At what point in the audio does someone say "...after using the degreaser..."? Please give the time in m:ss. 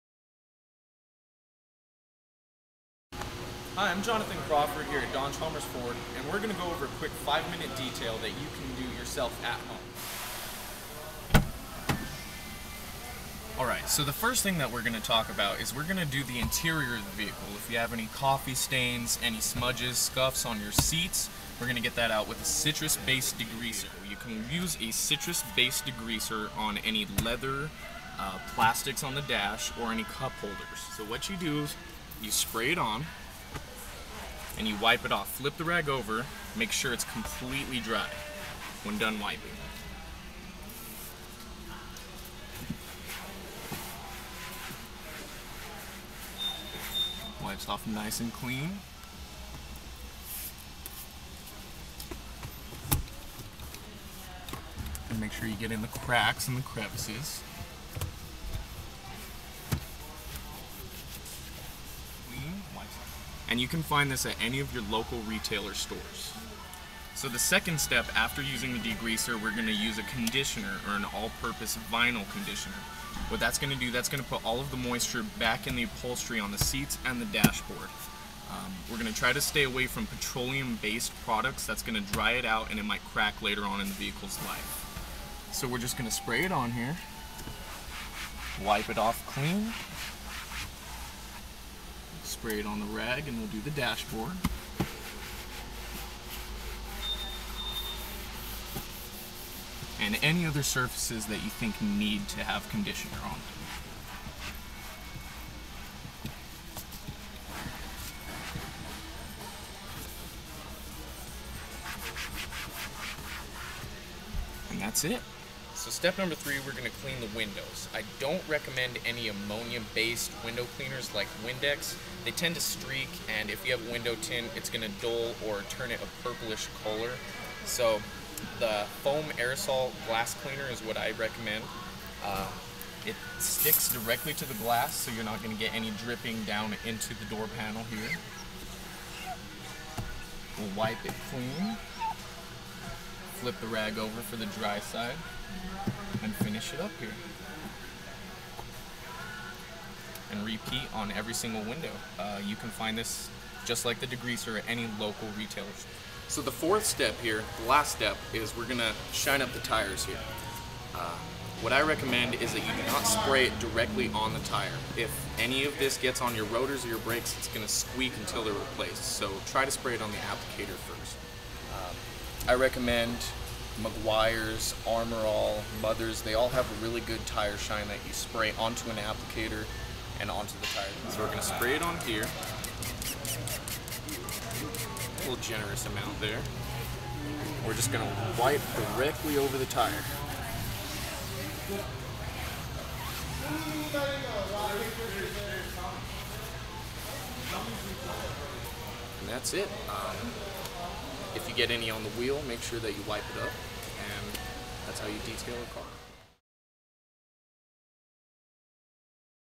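1:08.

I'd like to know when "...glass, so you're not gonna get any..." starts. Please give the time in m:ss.
2:14.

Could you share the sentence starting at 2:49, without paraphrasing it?
So try to spray it on the applicator first.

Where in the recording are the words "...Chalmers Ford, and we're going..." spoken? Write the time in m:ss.
0:05.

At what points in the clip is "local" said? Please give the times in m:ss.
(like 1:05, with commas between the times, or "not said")
1:04, 2:34.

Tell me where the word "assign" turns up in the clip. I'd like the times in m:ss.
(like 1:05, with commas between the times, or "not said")
not said.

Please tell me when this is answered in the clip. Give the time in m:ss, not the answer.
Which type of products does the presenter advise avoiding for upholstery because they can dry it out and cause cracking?
1:20.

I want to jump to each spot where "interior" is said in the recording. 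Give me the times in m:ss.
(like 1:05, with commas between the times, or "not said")
0:16.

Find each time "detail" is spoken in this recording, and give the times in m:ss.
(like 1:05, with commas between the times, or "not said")
0:07, 3:25.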